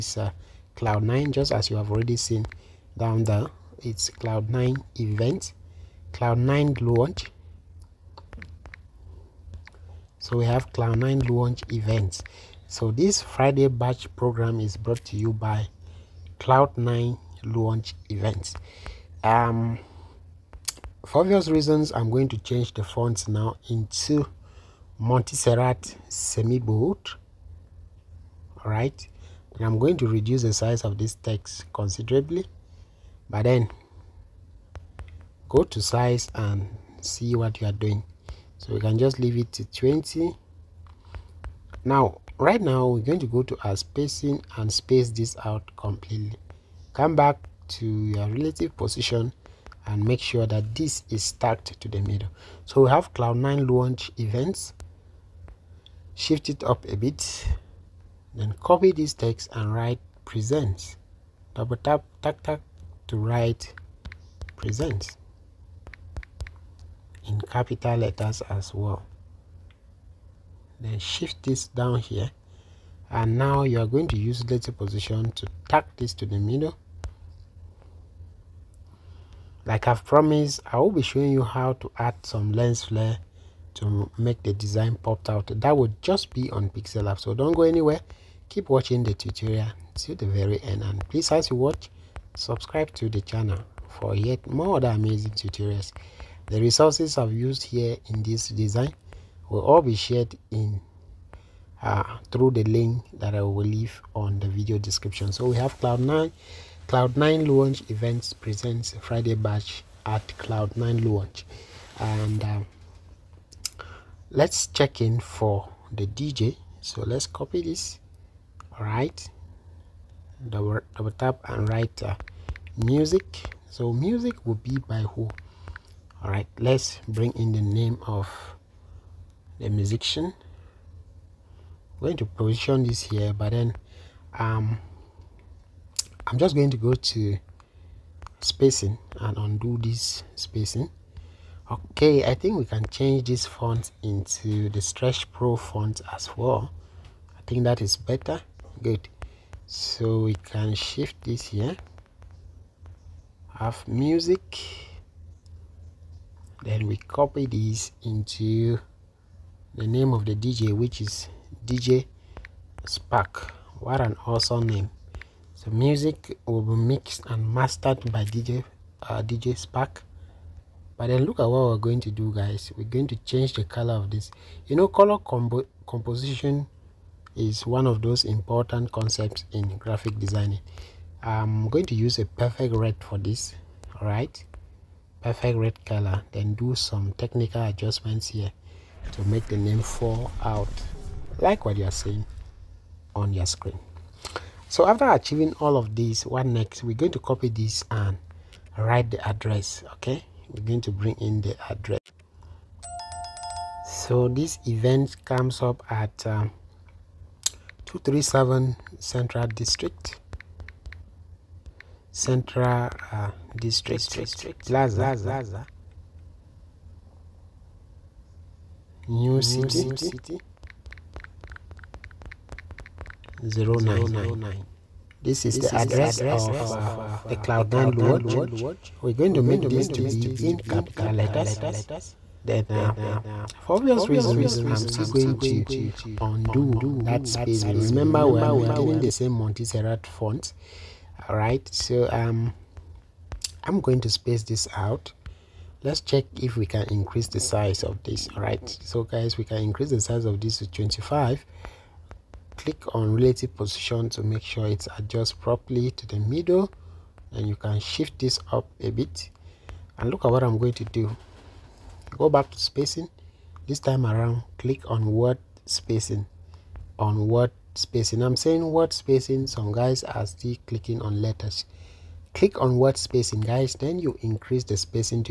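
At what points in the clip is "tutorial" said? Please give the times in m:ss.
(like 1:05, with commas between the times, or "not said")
1:29, 1:35.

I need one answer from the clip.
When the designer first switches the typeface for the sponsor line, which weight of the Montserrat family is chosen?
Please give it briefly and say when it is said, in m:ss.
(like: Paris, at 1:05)
semi-bold, at 0:26.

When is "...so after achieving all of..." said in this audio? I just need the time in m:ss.
3:14.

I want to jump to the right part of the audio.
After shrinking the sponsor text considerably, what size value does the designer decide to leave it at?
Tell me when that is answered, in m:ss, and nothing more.
0:39.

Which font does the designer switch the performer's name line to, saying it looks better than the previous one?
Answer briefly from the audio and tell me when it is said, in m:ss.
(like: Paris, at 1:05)
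Stretch Pro, at 2:24.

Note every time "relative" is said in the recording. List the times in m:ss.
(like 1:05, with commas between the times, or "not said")
0:48, 4:13.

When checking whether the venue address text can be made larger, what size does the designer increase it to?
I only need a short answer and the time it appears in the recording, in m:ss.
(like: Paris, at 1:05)
25, at 4:10.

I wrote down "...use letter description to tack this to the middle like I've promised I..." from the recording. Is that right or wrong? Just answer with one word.
wrong.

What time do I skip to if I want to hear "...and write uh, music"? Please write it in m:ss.
2:01.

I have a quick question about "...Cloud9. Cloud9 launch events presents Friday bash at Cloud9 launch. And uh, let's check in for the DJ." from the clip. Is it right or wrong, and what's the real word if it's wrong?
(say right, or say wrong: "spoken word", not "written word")
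right.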